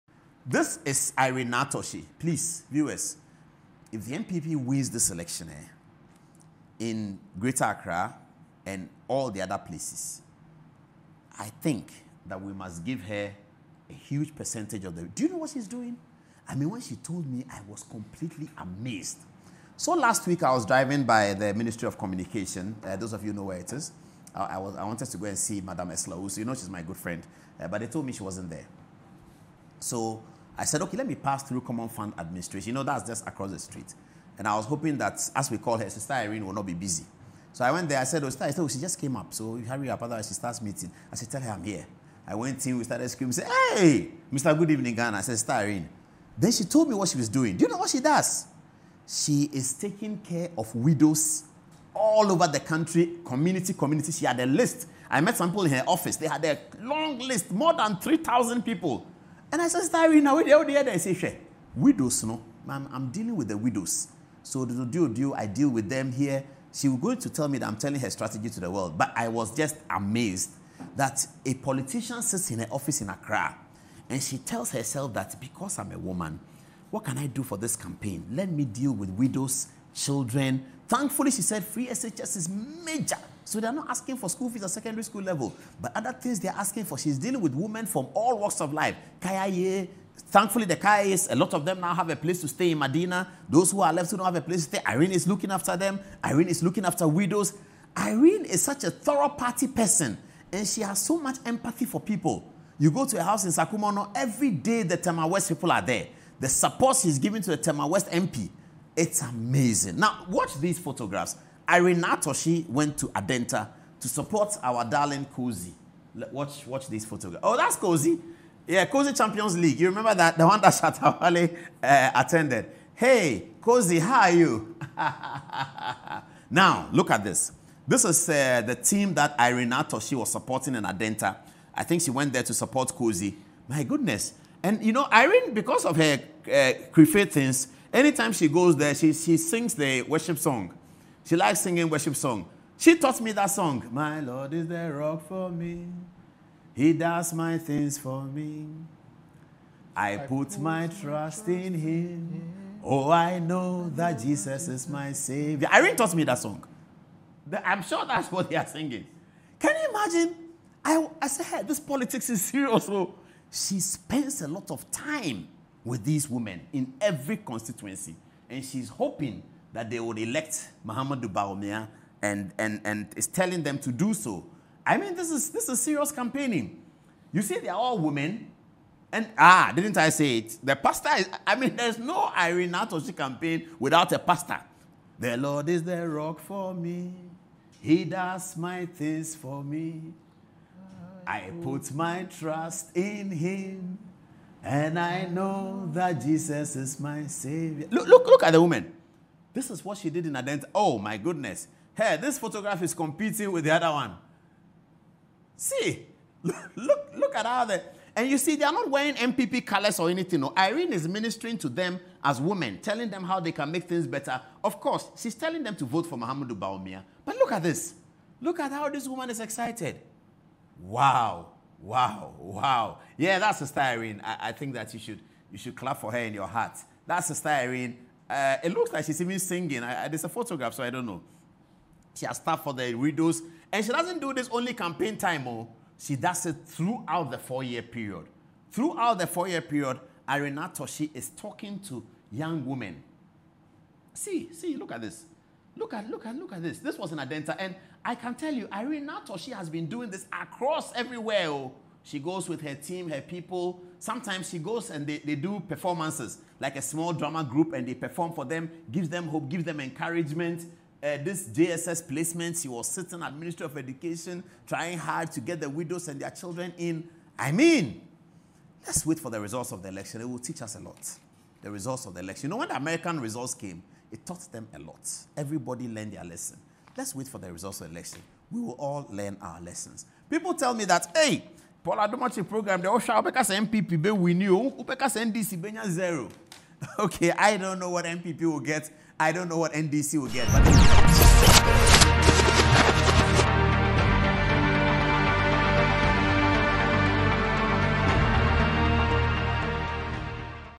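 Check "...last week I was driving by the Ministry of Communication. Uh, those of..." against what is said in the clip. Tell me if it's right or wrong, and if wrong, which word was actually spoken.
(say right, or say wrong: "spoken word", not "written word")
right.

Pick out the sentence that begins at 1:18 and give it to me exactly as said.
Let me deal with widows, children.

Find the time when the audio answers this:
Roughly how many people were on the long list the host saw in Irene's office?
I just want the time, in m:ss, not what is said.
0:57.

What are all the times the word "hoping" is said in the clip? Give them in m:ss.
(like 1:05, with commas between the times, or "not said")
0:34, 2:48.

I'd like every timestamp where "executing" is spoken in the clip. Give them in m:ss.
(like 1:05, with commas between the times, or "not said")
not said.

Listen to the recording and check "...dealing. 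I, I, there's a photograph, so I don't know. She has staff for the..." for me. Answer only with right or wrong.
wrong.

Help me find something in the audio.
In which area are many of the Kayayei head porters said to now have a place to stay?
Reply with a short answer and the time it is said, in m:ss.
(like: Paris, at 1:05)
Medina, at 1:32.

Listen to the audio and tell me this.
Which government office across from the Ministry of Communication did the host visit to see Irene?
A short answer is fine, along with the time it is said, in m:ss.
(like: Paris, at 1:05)
Common Fund Administration, at 0:31.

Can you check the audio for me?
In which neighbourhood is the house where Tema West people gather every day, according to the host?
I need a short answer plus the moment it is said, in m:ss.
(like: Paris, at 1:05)
Sakumono, at 1:43.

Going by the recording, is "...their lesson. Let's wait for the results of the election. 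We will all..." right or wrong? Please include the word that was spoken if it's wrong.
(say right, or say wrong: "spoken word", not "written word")
right.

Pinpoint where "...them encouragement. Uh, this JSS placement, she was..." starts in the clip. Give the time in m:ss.
4:19.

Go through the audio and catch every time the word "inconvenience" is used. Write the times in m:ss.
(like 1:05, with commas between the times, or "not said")
not said.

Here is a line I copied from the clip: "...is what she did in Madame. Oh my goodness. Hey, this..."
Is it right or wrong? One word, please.
wrong.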